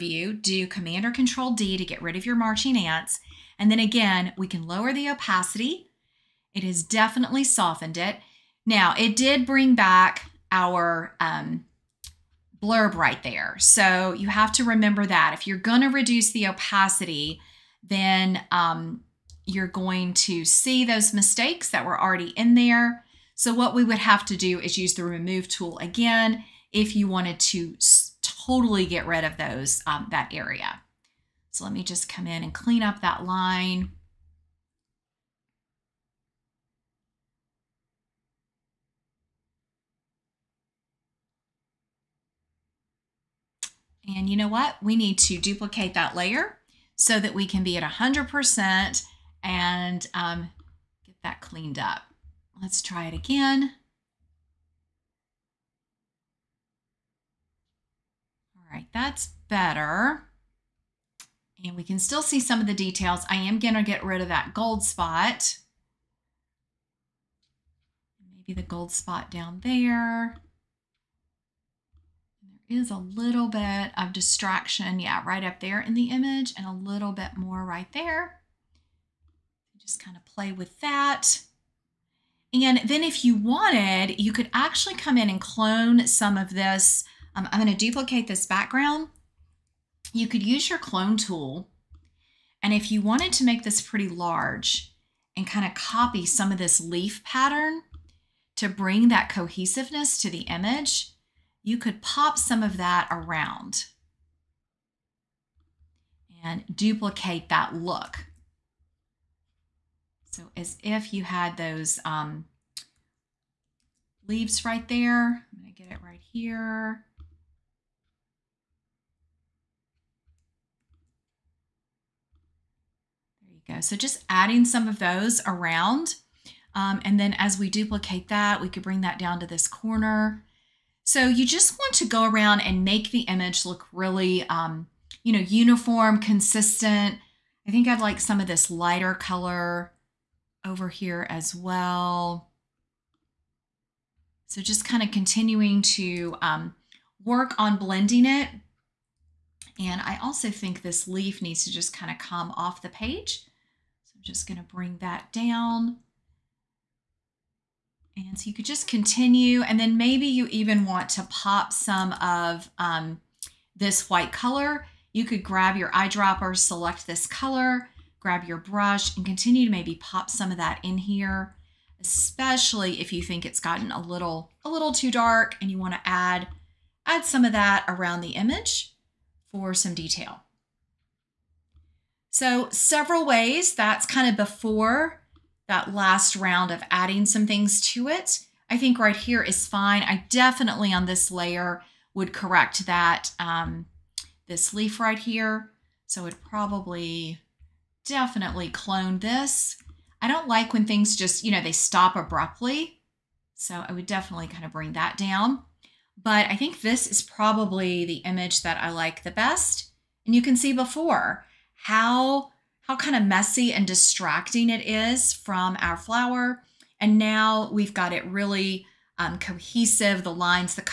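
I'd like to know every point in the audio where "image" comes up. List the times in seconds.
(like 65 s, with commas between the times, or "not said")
76 s, 100 s, 133 s, 178 s, 208 s.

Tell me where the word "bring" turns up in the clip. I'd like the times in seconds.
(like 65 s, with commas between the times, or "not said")
9 s, 98 s, 128 s, 154 s, 204 s.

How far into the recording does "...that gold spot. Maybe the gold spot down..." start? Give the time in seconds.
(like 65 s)
64 s.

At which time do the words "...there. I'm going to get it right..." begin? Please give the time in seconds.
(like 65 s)
114 s.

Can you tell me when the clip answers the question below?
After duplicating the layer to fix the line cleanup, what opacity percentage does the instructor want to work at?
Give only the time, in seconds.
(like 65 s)
47 s.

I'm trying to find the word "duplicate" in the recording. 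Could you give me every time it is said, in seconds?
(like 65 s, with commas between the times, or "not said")
45 s, 87 s, 106 s, 127 s.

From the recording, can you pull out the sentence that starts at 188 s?
I think right here is fine.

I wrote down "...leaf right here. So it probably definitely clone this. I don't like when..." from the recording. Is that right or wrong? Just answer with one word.
right.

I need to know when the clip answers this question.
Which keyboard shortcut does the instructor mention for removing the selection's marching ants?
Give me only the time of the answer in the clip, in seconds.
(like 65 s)
0 s.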